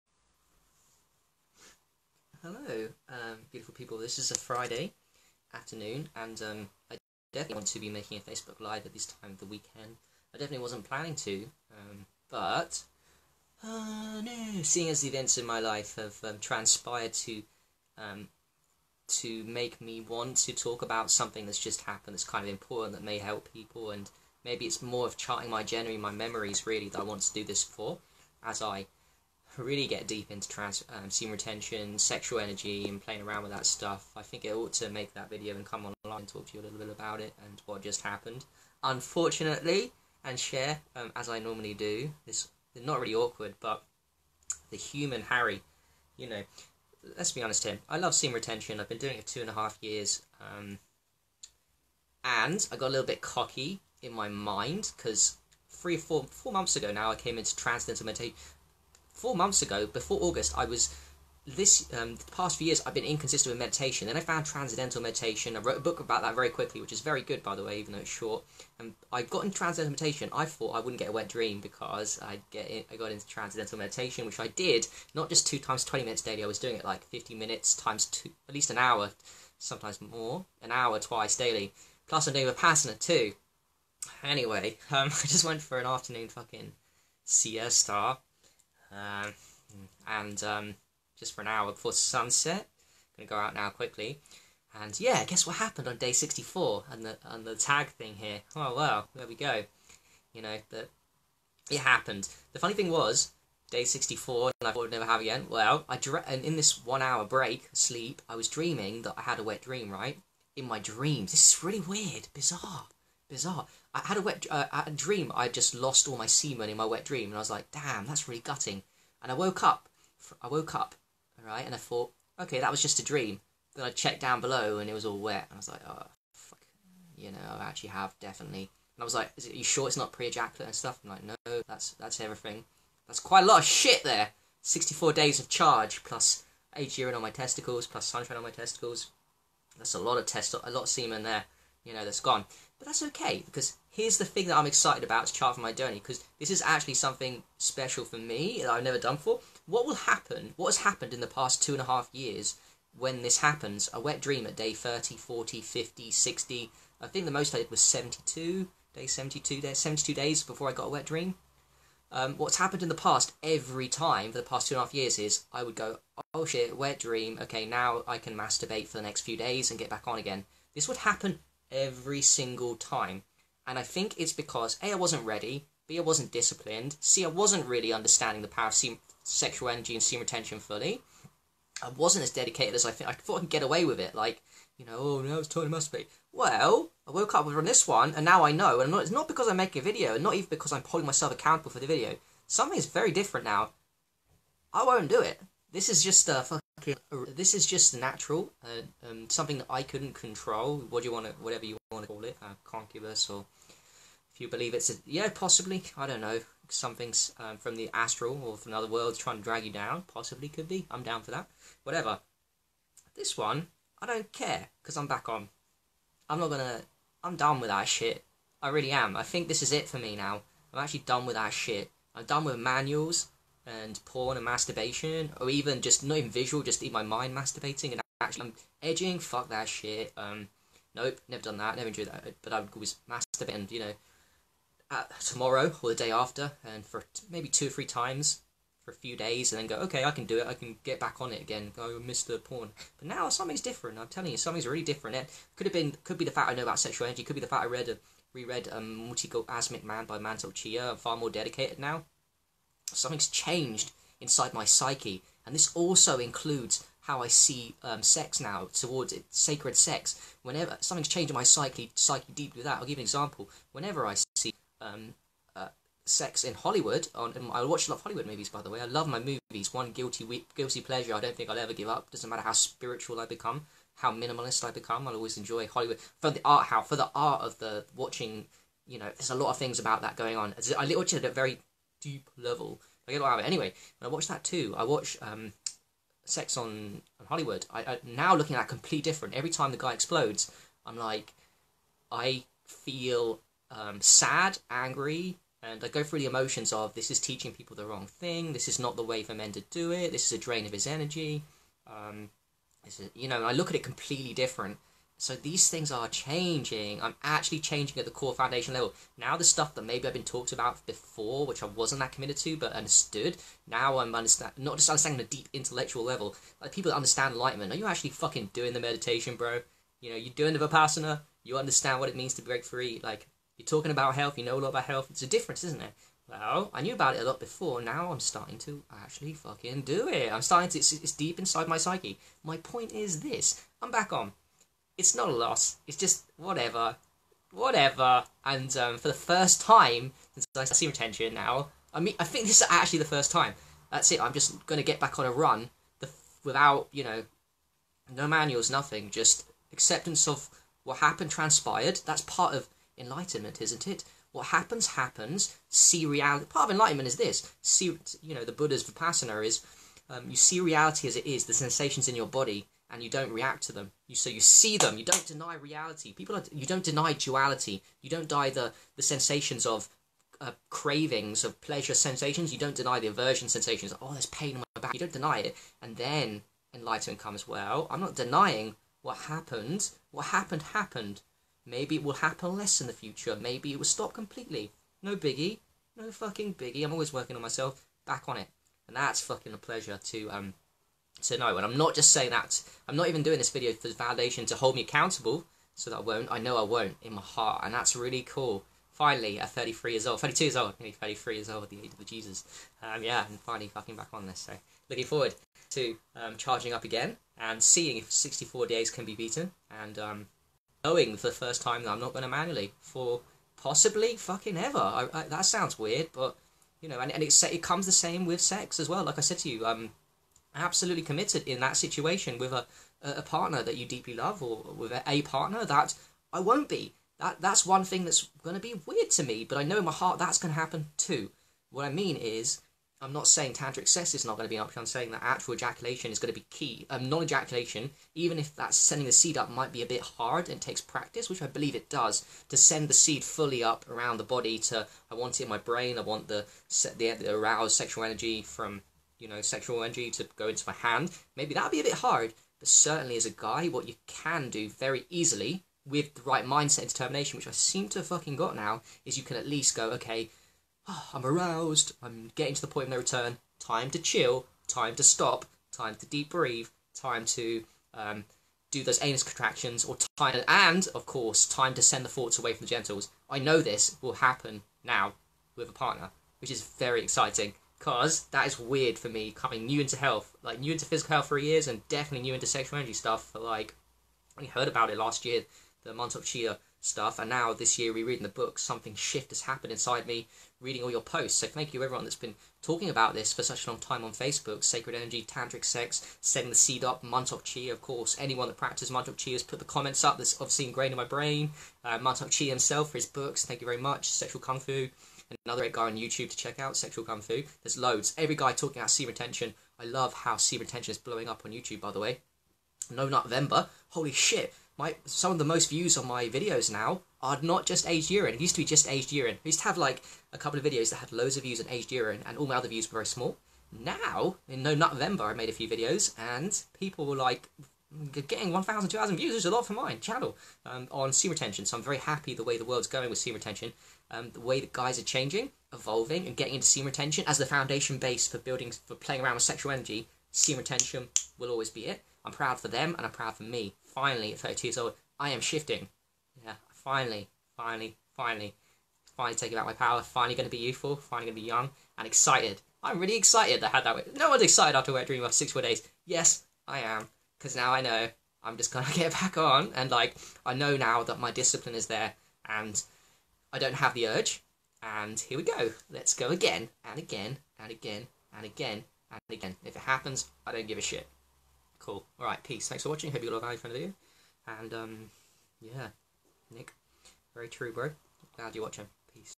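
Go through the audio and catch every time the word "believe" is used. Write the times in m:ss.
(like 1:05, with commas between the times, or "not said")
3:24, 7:21.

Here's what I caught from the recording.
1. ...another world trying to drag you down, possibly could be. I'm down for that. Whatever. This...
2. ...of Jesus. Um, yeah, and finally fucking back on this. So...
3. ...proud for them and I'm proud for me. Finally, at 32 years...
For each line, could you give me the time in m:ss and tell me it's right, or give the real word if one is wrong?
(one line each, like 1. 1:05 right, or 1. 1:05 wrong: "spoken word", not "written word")
1. 3:28 right
2. 6:41 right
3. 9:02 right.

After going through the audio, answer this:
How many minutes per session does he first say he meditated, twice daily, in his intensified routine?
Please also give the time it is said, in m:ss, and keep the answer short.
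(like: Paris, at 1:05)
50 minutes, at 1:17.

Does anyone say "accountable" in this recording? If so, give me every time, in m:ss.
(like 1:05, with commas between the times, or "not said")
3:11, 6:34.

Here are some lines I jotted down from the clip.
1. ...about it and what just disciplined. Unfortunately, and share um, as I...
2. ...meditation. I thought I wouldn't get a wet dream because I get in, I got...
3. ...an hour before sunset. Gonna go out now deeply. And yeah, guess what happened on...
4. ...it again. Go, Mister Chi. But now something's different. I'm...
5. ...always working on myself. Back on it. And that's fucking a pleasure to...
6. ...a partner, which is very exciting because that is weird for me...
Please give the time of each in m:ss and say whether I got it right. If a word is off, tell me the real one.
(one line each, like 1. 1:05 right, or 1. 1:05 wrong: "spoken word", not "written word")
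1. 0:36 wrong: "happened", not "disciplined"
2. 1:10 right
3. 1:31 wrong: "quickly", not "deeply"
4. 4:01 wrong: "Porn", not "Chi"
5. 6:26 right
6. 7:55 right.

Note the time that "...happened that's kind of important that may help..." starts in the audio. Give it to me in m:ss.
0:21.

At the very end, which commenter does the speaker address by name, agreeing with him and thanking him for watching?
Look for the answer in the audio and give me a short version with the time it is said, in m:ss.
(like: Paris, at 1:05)
Nick, at 9:36.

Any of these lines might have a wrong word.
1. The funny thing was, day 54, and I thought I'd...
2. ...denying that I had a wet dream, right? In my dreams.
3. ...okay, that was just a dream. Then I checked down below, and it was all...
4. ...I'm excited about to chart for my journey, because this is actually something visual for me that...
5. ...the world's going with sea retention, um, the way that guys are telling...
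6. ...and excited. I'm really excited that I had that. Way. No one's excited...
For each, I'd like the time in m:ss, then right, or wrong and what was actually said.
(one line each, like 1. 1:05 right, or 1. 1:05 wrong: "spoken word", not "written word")
1. 1:42 wrong: "64", not "54"
2. 1:48 wrong: "dreaming", not "denying"
3. 2:02 right
4. 2:24 wrong: "special", not "visual"
5. 8:52 wrong: "changing", not "telling"
6. 9:11 right.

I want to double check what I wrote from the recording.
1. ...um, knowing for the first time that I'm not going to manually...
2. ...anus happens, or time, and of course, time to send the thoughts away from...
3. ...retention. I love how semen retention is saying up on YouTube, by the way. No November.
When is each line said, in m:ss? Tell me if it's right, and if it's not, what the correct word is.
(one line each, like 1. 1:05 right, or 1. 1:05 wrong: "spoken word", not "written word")
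1. 6:49 right
2. 7:49 wrong: "contractions", not "happens"
3. 8:29 wrong: "blowing", not "saying".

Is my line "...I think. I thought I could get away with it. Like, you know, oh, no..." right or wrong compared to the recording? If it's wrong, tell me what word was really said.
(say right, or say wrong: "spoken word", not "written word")
right.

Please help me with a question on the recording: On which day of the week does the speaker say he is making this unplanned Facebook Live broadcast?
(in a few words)
Friday.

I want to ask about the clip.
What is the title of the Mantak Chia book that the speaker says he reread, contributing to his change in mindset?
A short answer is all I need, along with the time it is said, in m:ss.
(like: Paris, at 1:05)
Multi-Orgasmic Man, at 4:09.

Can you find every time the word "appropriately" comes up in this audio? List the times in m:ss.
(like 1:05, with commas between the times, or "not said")
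not said.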